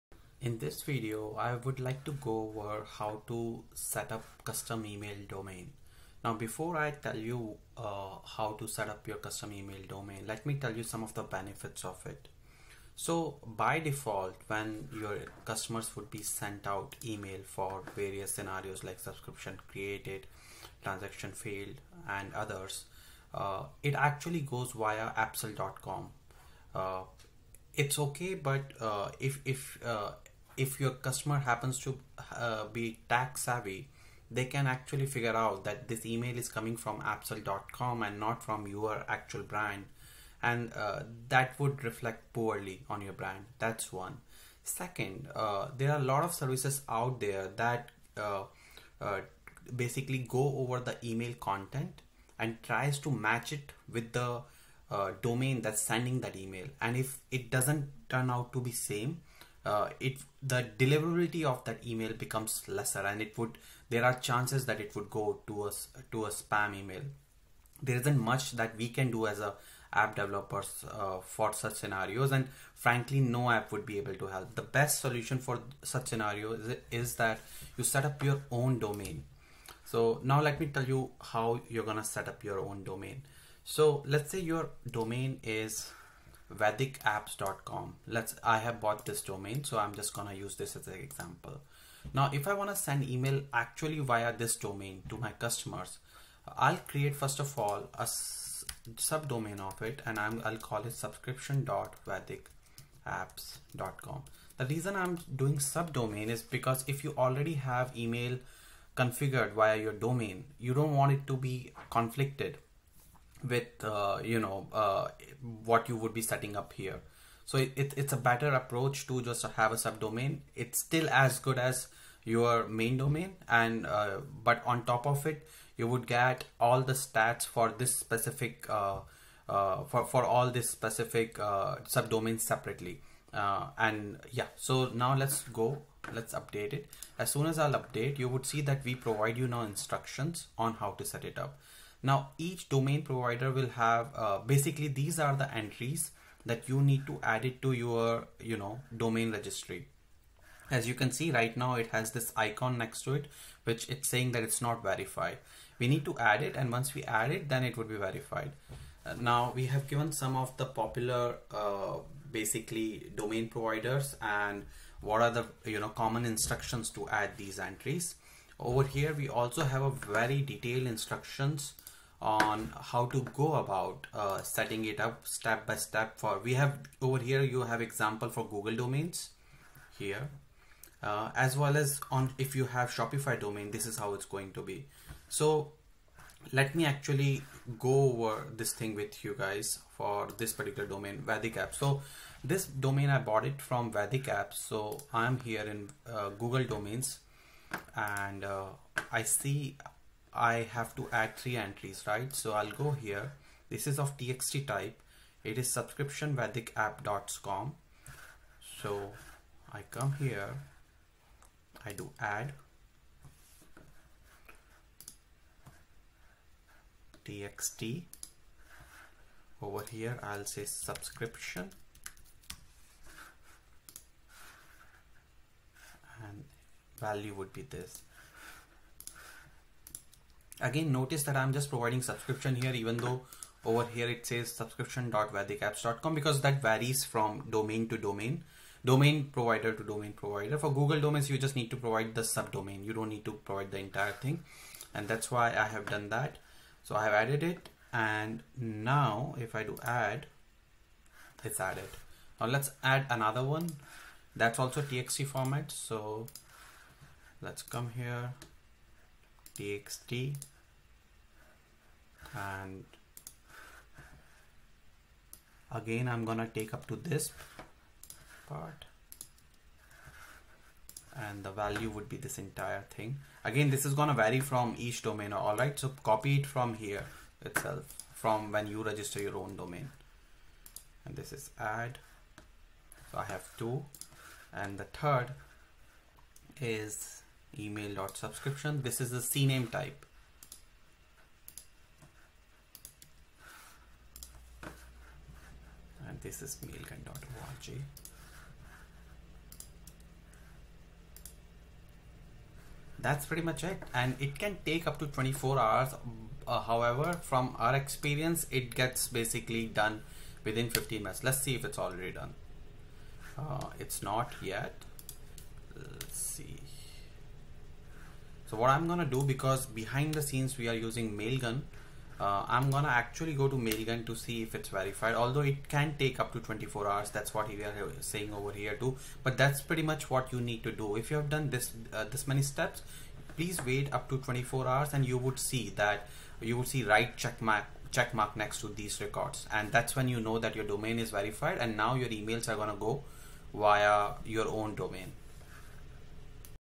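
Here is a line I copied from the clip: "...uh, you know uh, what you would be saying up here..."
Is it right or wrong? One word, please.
wrong.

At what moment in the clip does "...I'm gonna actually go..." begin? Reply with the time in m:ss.
5:22.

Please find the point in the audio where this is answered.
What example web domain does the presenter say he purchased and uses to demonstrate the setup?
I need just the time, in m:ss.
1:26.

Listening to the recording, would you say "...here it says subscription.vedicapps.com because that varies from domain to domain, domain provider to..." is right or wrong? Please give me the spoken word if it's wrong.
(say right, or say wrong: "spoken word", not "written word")
right.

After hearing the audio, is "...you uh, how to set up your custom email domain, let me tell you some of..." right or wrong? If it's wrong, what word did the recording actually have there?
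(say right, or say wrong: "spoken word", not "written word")
right.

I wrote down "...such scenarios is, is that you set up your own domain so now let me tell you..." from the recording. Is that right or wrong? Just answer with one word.
right.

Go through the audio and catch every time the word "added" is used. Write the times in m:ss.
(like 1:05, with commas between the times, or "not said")
4:07, 4:11.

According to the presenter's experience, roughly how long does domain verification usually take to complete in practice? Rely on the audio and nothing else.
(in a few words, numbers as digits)
15 minutes.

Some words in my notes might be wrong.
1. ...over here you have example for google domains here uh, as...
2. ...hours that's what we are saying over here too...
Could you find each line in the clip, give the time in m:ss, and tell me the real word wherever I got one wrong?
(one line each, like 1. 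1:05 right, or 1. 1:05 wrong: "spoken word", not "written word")
1. 2:57 right
2. 5:26 right.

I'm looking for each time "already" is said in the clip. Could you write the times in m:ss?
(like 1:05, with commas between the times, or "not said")
1:47, 5:11.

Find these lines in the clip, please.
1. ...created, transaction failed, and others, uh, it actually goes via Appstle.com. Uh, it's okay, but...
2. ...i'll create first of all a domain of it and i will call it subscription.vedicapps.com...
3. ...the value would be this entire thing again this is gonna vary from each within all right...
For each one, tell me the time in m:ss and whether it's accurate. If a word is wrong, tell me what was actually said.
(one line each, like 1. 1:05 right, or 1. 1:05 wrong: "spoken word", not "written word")
1. 0:19 right
2. 1:36 wrong: "subdomain", not "domain"
3. 4:31 wrong: "domain", not "within".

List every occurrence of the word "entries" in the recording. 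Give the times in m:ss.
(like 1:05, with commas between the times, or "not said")
2:25, 2:47, 3:21.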